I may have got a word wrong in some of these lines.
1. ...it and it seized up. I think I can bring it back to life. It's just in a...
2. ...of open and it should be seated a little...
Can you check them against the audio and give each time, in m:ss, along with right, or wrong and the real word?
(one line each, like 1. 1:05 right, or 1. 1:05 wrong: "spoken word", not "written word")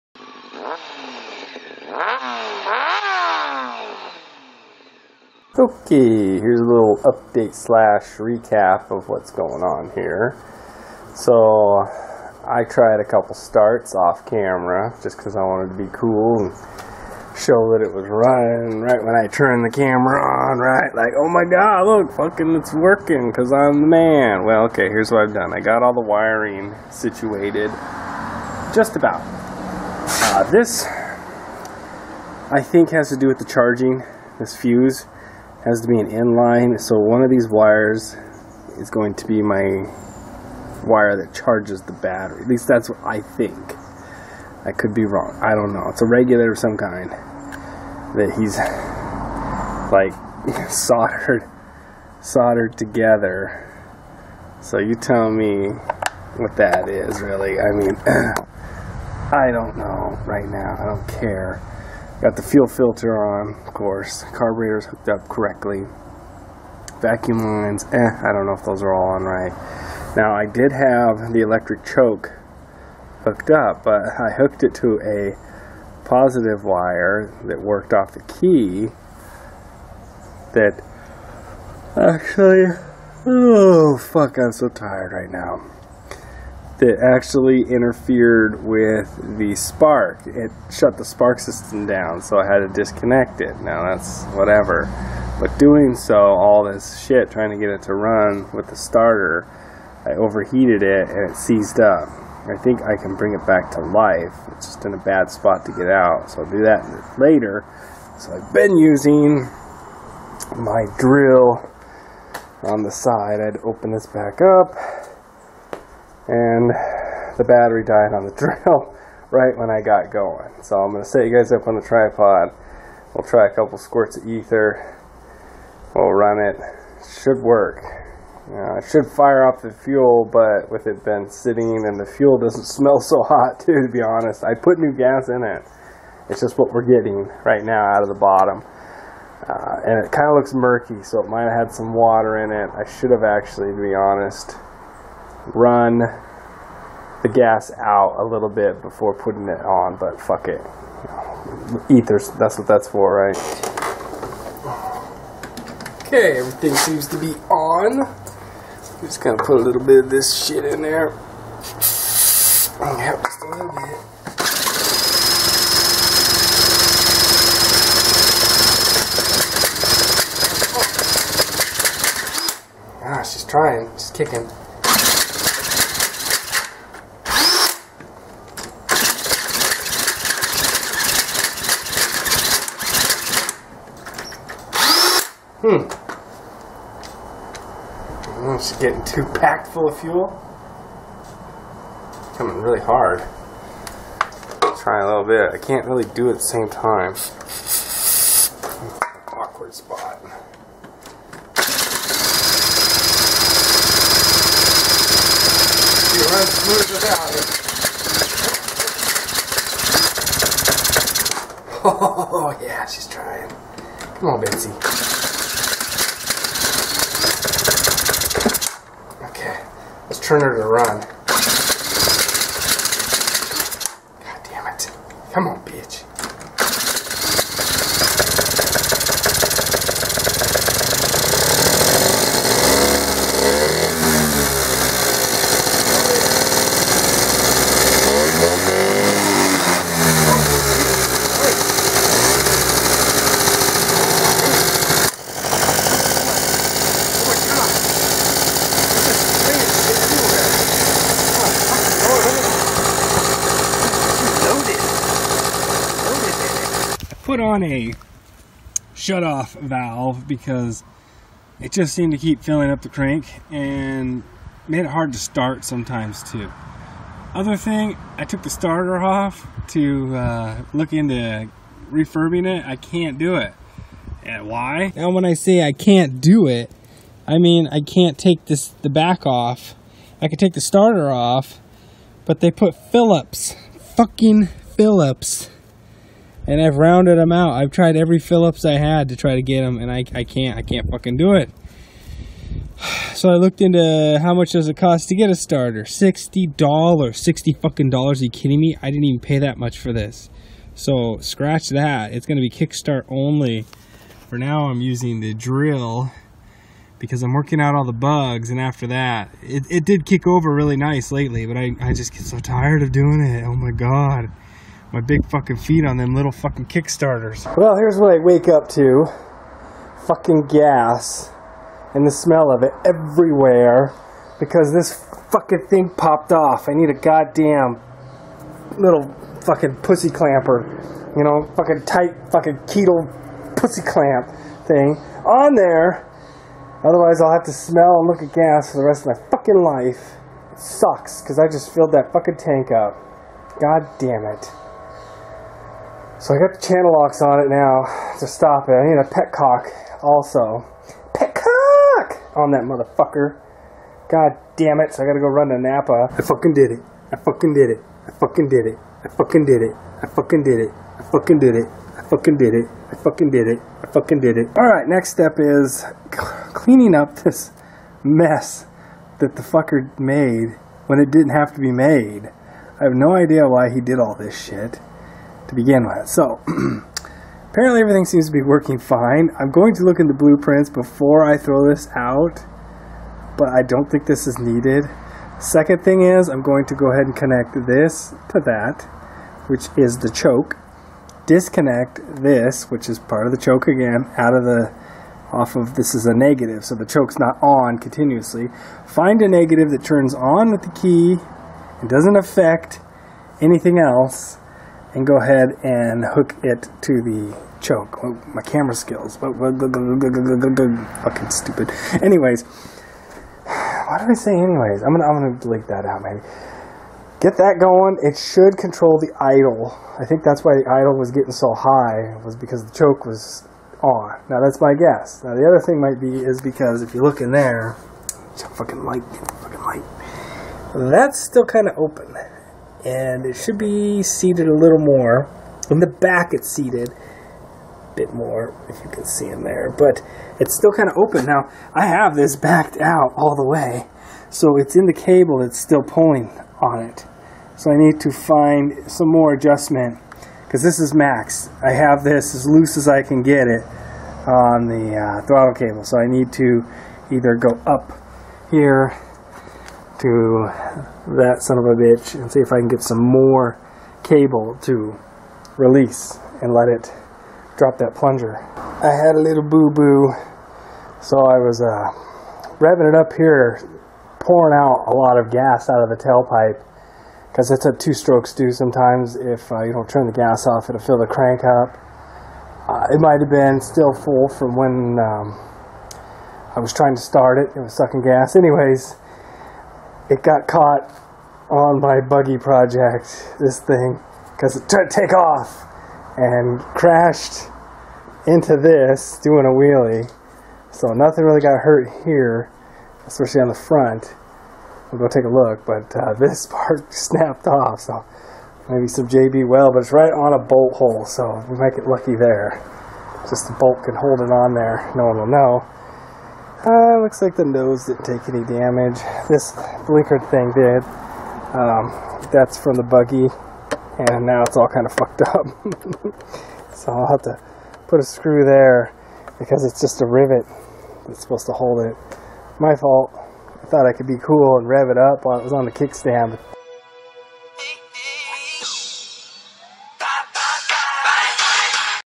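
1. 1:40 right
2. 7:11 right.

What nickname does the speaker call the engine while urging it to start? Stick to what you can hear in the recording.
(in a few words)
Betsy.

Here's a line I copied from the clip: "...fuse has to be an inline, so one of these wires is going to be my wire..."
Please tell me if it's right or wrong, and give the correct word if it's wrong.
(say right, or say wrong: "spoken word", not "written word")
right.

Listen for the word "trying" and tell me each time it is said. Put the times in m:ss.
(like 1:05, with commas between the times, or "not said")
1:37, 2:53, 3:33, 8:06.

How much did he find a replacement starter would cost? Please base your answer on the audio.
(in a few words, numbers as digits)
$60.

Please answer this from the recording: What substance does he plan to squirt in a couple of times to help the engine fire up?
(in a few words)
ether.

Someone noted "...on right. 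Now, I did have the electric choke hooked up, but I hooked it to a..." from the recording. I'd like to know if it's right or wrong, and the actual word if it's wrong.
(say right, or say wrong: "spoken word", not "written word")
right.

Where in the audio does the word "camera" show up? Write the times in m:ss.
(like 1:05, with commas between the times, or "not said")
0:14, 0:19, 6:48.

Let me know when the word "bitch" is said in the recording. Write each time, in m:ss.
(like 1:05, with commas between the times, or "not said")
3:45, 7:41.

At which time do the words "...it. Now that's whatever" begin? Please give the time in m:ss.
1:33.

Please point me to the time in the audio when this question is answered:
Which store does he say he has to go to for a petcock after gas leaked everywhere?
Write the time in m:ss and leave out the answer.
5:55.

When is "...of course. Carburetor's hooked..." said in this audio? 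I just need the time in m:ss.
1:03.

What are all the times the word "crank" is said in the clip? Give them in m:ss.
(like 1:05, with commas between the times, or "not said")
4:22, 8:01.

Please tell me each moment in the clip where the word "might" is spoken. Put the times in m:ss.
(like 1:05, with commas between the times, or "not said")
2:21, 7:05, 8:02, 8:31.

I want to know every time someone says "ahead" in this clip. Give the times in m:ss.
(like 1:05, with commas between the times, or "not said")
6:26, 6:45.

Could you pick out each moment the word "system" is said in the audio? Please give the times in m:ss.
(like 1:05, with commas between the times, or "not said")
1:31.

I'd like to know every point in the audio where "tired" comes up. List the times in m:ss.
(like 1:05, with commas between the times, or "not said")
1:24, 5:12.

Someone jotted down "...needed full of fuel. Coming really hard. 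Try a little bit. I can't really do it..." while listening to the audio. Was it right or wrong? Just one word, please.
wrong.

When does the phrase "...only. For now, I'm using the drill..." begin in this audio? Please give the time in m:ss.
5:03.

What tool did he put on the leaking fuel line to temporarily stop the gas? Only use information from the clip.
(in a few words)
channel locks.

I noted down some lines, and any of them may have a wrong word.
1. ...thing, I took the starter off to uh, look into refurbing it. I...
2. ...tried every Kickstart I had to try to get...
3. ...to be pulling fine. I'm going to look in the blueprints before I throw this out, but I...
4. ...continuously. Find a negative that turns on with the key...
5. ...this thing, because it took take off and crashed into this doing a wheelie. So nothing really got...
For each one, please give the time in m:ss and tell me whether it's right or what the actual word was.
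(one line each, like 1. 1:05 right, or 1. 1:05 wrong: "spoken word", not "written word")
1. 4:27 right
2. 4:47 wrong: "Phillips", not "Kickstart"
3. 6:18 wrong: "working", not "pulling"
4. 6:37 right
5. 8:13 right.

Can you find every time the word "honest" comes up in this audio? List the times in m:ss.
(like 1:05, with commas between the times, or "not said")
2:13, 2:23.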